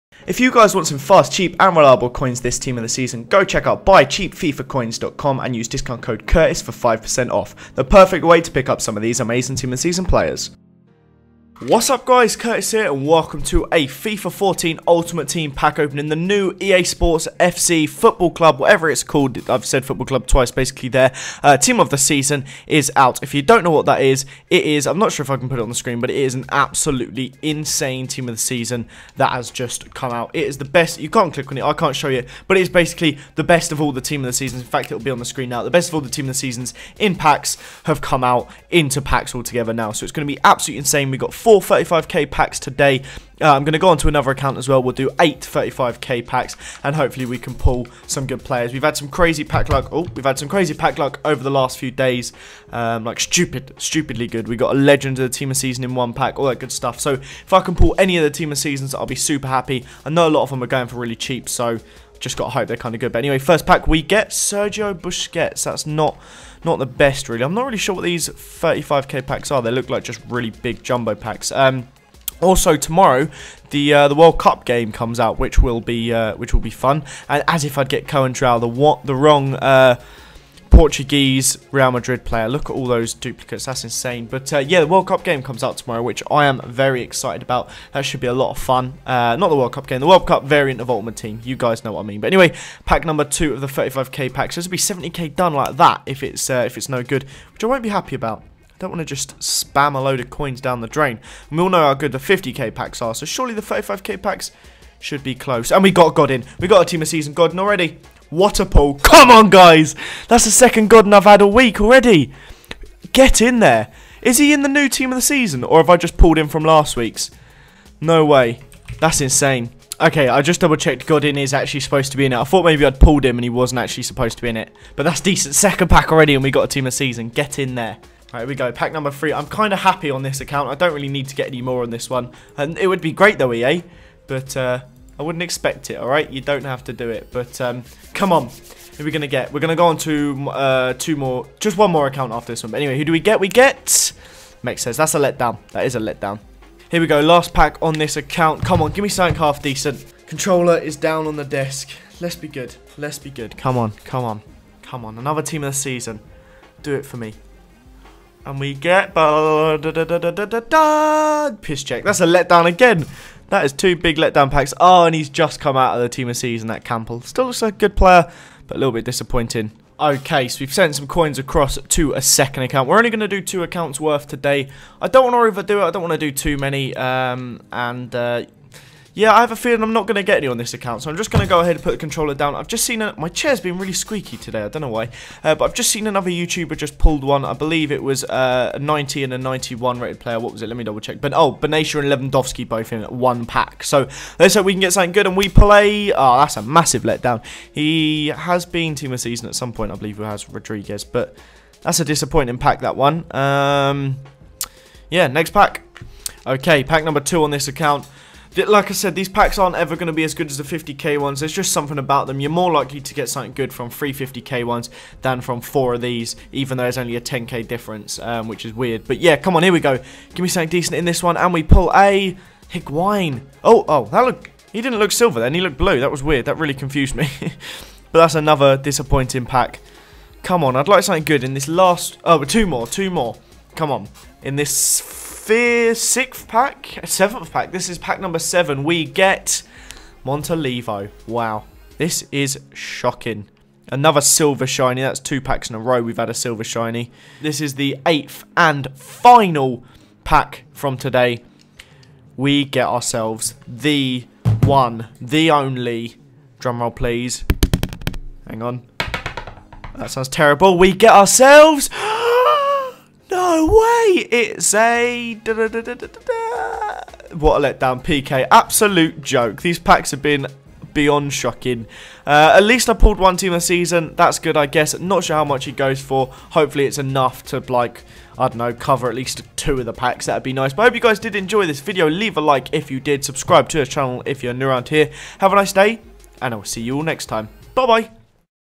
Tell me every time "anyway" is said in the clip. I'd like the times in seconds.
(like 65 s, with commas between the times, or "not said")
63 s, 92 s, 142 s.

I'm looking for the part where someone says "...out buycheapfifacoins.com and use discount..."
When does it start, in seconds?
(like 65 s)
3 s.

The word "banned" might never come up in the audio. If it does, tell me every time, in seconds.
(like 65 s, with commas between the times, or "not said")
not said.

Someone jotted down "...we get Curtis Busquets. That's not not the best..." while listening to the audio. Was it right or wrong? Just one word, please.
wrong.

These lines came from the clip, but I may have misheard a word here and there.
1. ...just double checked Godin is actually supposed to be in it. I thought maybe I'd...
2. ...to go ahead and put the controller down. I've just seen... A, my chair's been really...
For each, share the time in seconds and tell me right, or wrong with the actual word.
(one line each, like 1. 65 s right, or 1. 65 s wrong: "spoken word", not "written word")
1. 120 s right
2. 181 s right.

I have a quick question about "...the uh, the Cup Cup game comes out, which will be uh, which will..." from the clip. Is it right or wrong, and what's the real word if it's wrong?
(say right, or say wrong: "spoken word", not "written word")
wrong: "World", not "Cup".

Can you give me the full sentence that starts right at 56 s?
So if I can pull any of the team of seasons, I'll be super happy.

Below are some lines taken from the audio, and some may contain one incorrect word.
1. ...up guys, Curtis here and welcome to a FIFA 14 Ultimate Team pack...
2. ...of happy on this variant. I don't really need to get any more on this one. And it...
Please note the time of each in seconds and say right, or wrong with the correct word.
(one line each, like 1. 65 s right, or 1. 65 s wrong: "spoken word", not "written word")
1. 11 s right
2. 129 s wrong: "account", not "variant".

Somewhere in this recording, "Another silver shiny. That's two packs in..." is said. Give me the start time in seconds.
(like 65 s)
243 s.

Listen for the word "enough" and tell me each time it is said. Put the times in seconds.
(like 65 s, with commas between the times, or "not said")
276 s.